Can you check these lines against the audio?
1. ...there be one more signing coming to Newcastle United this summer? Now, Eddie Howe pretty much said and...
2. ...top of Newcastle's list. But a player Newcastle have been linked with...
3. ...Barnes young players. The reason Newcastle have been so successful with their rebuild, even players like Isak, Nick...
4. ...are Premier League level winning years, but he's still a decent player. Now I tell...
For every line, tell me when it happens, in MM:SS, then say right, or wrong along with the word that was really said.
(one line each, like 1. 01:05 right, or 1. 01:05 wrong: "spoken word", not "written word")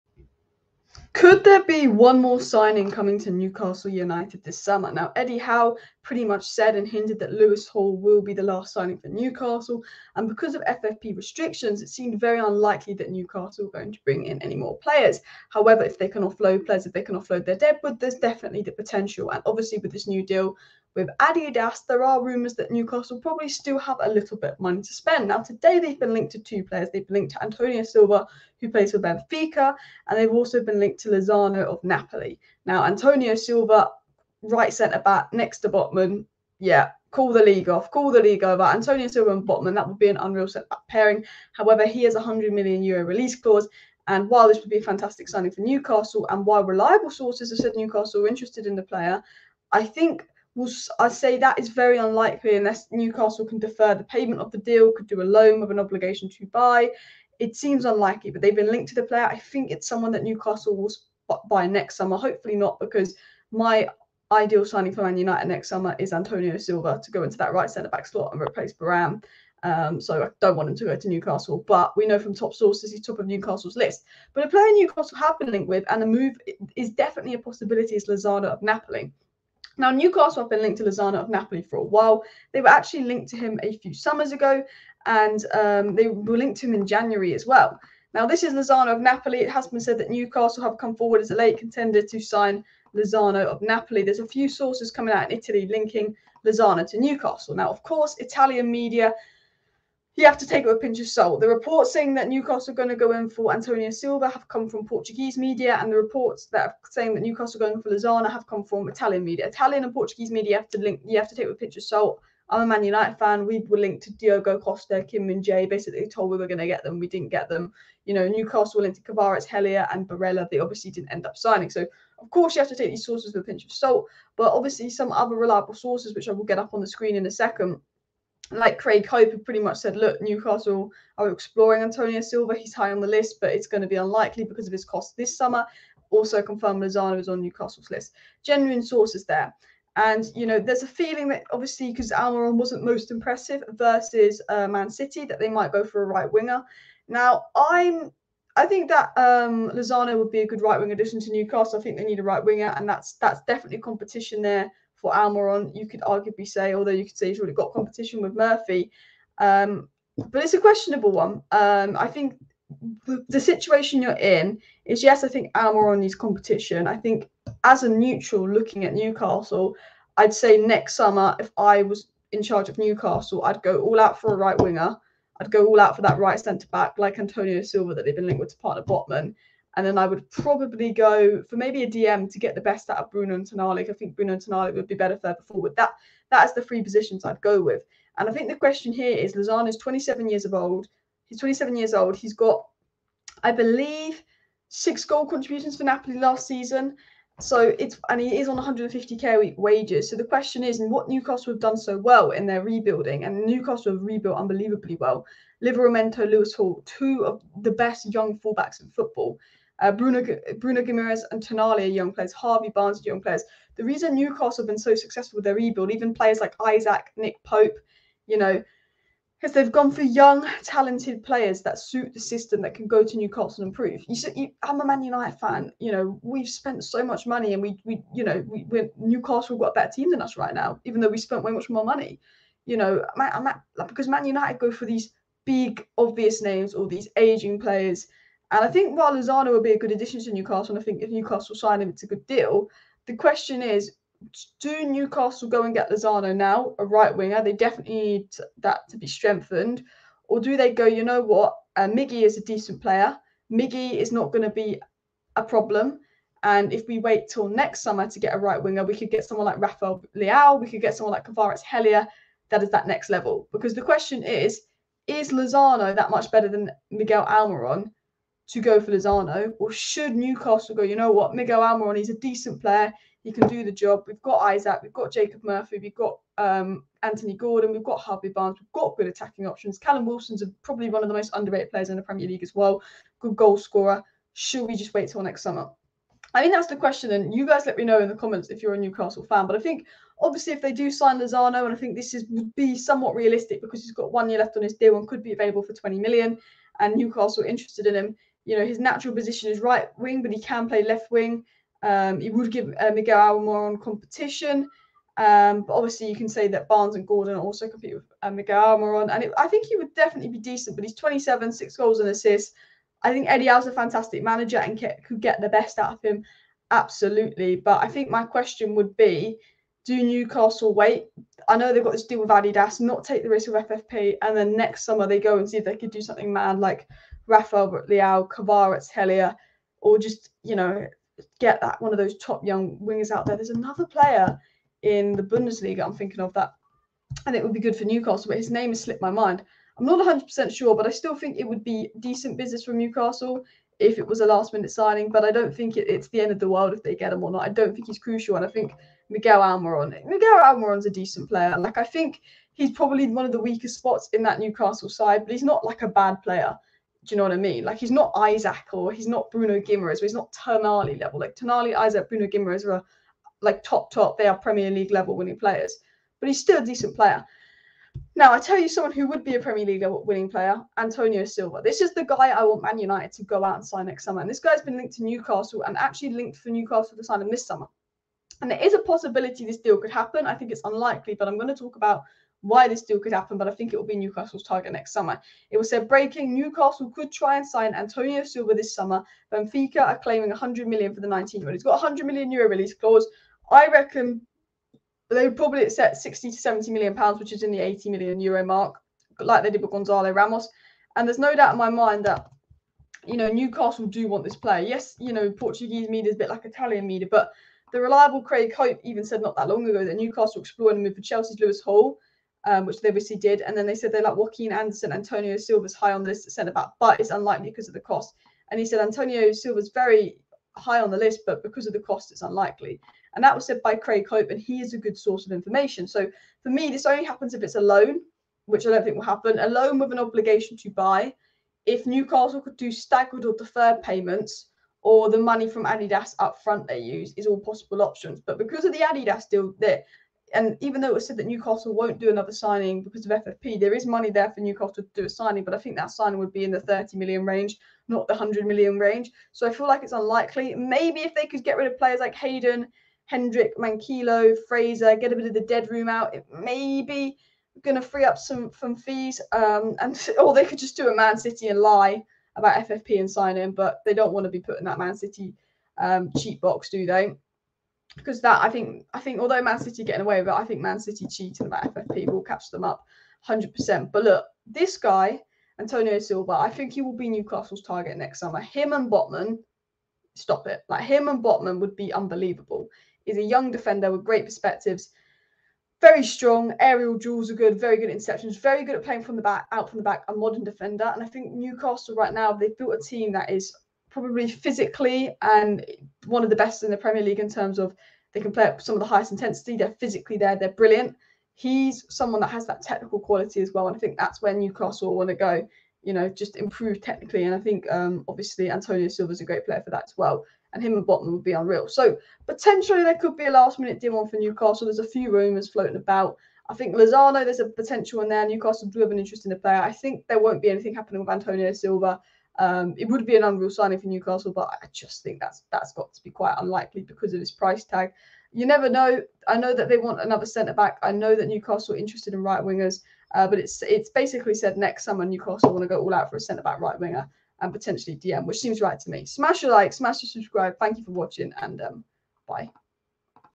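1. 00:01 right
2. 01:13 right
3. 03:32 right
4. 06:04 wrong: "players", not "years".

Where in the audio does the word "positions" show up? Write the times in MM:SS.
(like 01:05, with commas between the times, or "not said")
03:06, 04:59.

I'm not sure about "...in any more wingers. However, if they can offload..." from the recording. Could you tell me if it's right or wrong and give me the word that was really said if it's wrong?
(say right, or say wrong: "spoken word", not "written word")
wrong: "players", not "wingers".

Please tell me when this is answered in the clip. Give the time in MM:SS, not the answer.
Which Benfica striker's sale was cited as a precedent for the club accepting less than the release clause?
06:39.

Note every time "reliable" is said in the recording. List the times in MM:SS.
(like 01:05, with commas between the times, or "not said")
00:46, 02:05, 06:47.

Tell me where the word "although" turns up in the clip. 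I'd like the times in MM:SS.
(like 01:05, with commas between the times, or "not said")
02:36, 07:49.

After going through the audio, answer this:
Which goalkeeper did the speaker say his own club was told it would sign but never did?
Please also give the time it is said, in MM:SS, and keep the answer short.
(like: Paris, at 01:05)
Diogo Costa, at 01:54.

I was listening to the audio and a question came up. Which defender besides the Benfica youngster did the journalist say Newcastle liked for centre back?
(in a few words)
Joachim Andersen.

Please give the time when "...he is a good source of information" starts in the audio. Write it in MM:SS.
07:04.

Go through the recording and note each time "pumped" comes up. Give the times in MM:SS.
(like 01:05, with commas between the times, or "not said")
not said.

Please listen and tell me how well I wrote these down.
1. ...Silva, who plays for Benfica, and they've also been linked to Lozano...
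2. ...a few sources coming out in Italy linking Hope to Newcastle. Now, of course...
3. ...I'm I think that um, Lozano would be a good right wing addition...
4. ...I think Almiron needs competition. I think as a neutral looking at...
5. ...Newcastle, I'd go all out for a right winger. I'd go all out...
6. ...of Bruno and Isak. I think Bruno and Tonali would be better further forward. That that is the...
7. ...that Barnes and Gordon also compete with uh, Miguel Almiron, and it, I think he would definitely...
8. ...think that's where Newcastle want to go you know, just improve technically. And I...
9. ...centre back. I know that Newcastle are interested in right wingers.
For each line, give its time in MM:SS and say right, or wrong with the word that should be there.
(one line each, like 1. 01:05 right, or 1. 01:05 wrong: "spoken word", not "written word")
1. 00:27 right
2. 01:34 wrong: "Lozano", not "Hope"
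3. 02:27 right
4. 02:45 right
5. 02:52 right
6. 03:02 wrong: "Tonali", not "Isak"
7. 05:06 right
8. 08:23 right
9. 08:50 right.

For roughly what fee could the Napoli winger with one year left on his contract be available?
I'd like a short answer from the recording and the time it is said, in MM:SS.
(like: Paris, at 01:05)
20 million, at 04:55.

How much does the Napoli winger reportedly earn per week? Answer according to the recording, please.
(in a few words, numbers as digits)
150k.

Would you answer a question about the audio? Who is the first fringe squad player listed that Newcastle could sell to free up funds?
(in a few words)
Hayden.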